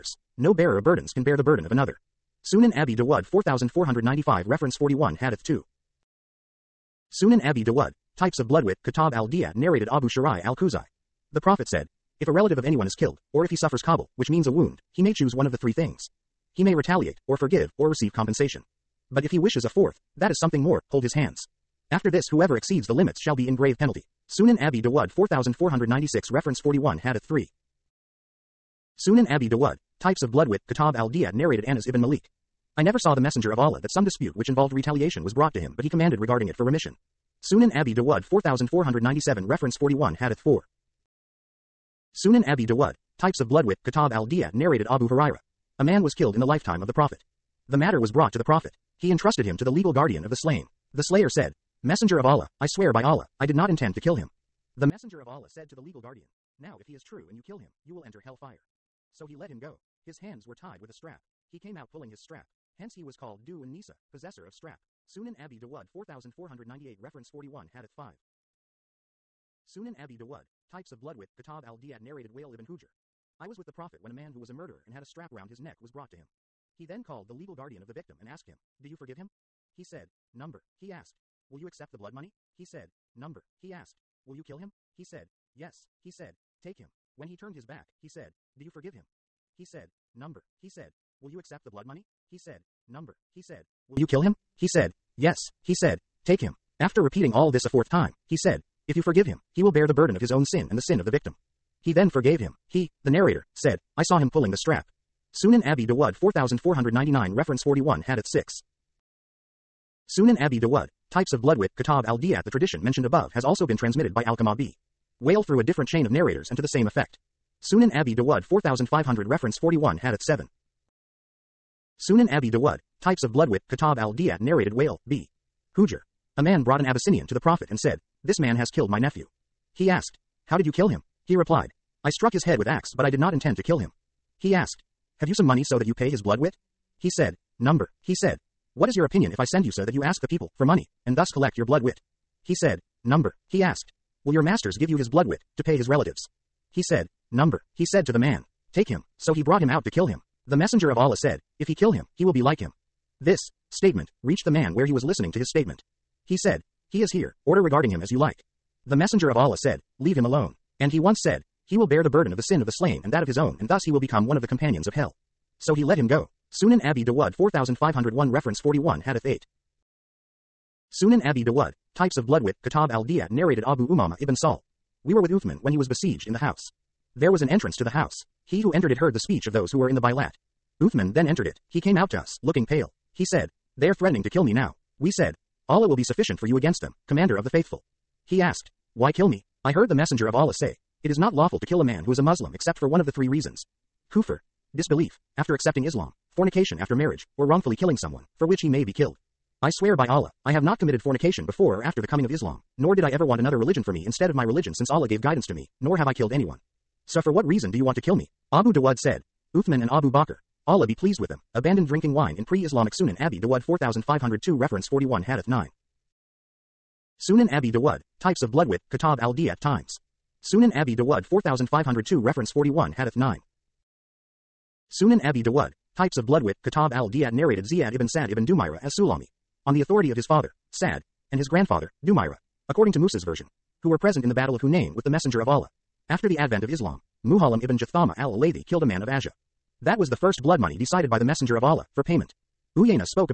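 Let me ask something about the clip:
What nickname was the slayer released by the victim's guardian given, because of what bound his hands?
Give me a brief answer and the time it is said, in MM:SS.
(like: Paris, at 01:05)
Du Anisa, at 01:03.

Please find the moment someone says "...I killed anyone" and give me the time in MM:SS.
03:26.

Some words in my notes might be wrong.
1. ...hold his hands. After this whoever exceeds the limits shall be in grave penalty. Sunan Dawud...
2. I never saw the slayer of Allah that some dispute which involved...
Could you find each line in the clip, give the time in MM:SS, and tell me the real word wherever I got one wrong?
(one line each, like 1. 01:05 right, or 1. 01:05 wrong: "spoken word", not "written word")
1. 00:20 wrong: "Abi", not "Dawud"
2. 00:32 wrong: "messenger", not "slayer".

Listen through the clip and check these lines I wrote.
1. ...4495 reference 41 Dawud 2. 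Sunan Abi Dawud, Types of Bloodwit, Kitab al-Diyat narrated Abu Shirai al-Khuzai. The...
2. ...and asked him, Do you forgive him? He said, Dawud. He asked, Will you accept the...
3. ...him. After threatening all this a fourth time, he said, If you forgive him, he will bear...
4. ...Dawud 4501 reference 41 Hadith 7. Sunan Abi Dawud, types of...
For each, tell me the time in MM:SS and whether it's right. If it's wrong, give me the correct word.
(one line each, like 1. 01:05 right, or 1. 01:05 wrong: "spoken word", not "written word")
1. 00:03 wrong: "Hadith", not "Dawud"
2. 01:18 wrong: "Number", not "Dawud"
3. 01:36 wrong: "repeating", not "threatening"
4. 01:58 wrong: "4500", not "4501".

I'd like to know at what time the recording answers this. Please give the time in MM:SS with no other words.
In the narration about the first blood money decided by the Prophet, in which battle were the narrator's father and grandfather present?
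03:54.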